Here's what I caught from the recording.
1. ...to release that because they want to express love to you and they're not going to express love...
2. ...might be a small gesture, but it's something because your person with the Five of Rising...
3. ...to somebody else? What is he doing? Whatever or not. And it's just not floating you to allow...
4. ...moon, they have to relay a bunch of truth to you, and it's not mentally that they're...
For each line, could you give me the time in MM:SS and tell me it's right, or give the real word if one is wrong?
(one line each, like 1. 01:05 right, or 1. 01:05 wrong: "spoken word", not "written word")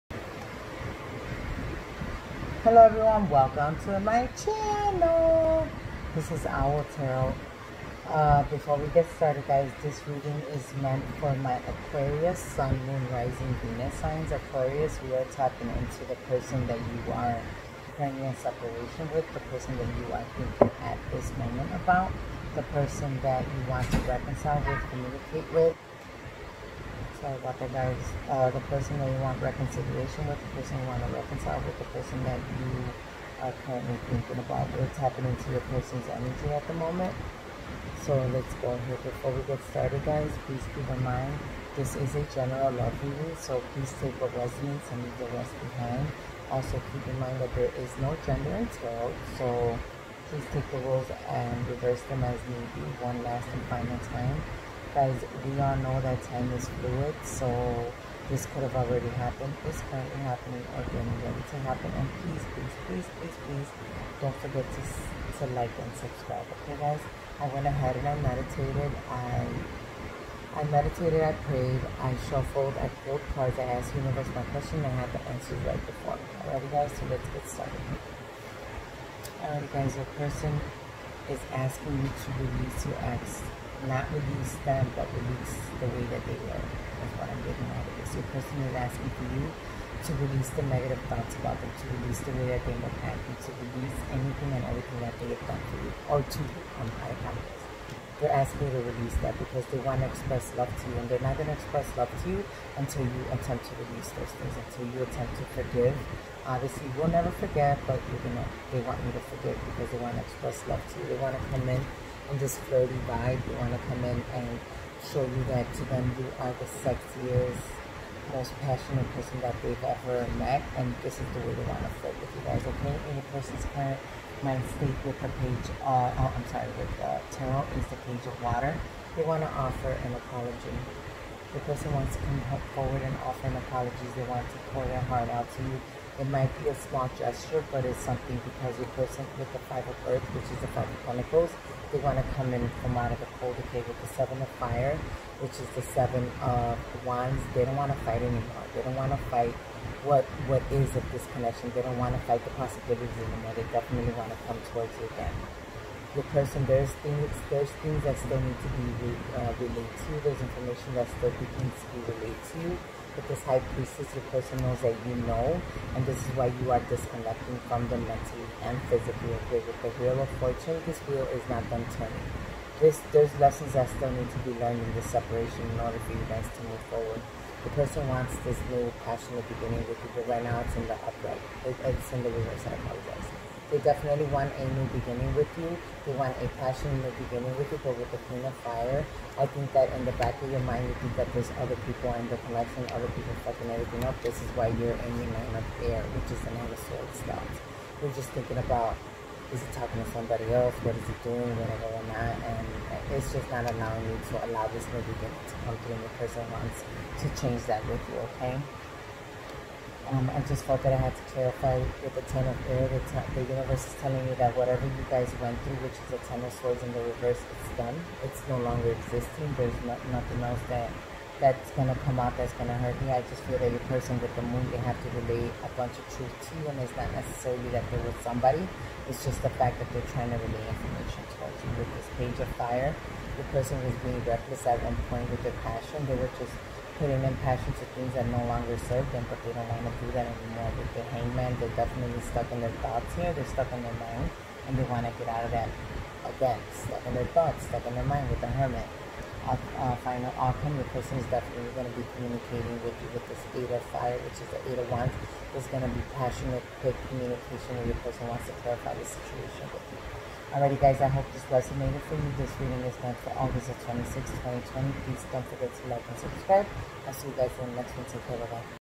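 1. 01:38 right
2. 02:16 wrong: "Earth", not "Rising"
3. 03:20 wrong: "allowing", not "floating"
4. 03:44 wrong: "necessarily", not "mentally".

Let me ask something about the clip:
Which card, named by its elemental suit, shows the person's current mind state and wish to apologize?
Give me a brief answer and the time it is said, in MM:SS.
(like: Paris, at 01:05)
Page of Water, at 02:08.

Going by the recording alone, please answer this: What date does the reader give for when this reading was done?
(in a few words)
August 26, 2020.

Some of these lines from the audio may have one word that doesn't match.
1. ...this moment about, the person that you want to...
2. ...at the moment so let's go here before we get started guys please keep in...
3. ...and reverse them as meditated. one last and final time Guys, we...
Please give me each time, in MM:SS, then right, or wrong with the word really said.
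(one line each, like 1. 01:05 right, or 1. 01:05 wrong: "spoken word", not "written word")
1. 00:21 right
2. 00:36 right
3. 00:51 wrong: "needed", not "meditated".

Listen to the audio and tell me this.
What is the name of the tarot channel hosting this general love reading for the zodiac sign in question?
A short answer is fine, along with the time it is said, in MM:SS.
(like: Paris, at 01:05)
Owl Tarot, at 00:06.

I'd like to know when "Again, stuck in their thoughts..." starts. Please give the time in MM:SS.
04:06.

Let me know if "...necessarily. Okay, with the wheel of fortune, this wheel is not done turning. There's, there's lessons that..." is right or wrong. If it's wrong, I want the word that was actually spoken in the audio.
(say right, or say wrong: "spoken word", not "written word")
wrong: "physically", not "necessarily".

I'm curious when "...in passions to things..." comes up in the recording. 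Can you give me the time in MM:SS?
03:57.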